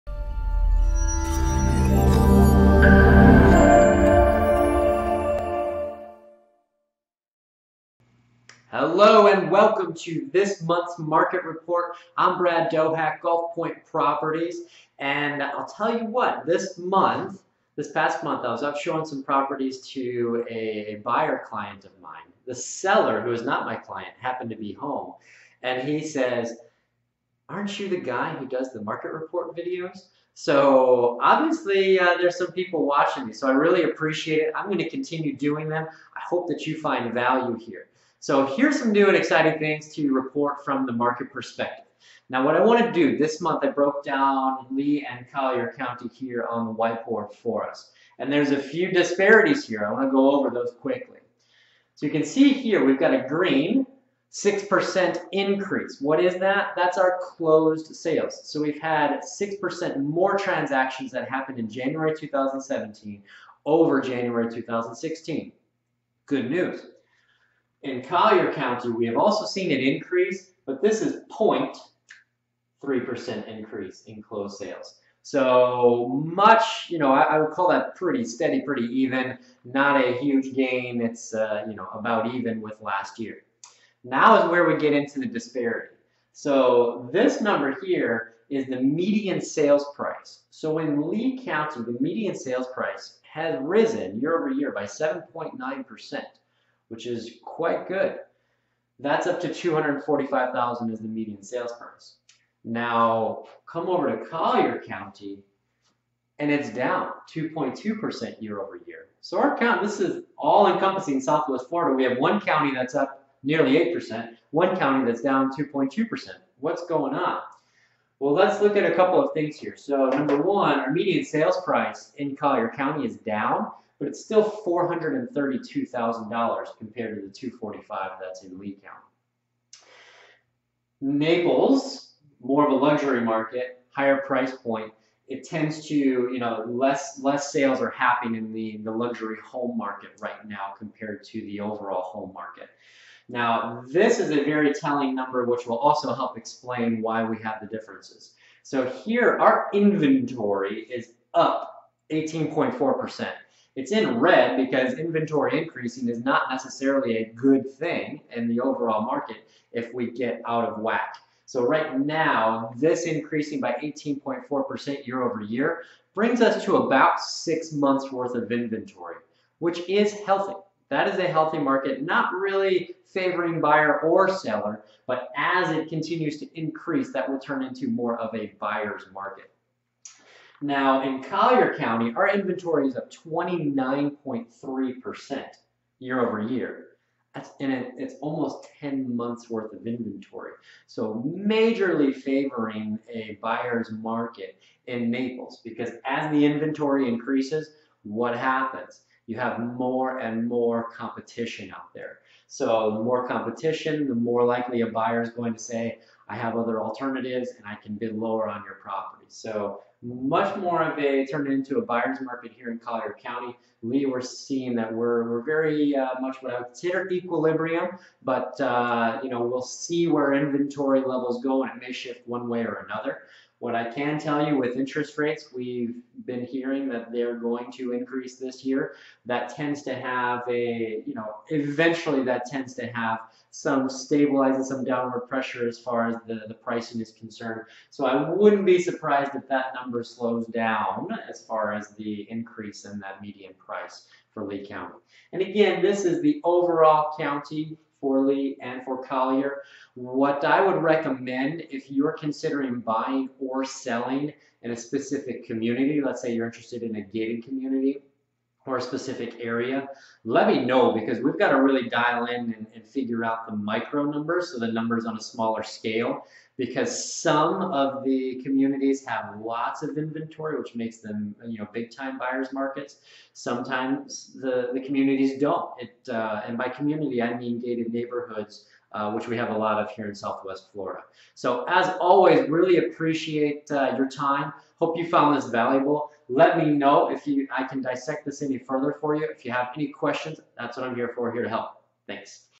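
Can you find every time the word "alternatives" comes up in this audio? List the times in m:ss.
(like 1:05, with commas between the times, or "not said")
3:26.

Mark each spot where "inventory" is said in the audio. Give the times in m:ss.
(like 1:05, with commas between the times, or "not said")
2:29, 2:34, 2:48, 3:02, 3:09, 3:16, 3:40, 4:29.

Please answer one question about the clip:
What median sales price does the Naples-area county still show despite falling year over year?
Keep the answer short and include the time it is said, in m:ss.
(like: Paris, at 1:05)
$432,000, at 2:04.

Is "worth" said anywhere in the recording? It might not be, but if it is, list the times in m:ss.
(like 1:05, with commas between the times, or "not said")
2:48, 3:09.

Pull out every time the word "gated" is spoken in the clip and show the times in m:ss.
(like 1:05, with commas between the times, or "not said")
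4:17, 4:37.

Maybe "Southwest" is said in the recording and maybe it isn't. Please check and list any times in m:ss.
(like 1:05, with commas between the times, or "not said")
1:51, 4:40.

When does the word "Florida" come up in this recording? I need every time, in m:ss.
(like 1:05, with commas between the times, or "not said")
1:51, 4:40.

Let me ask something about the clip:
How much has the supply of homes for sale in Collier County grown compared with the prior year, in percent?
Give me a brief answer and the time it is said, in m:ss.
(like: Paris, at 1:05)
29.3%, at 3:03.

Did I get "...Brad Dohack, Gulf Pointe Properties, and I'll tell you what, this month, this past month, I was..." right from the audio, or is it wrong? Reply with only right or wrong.
right.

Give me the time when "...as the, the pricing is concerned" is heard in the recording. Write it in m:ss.
3:56.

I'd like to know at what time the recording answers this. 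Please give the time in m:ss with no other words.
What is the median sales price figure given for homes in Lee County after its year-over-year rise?
1:39.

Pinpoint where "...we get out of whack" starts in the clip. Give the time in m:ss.
2:39.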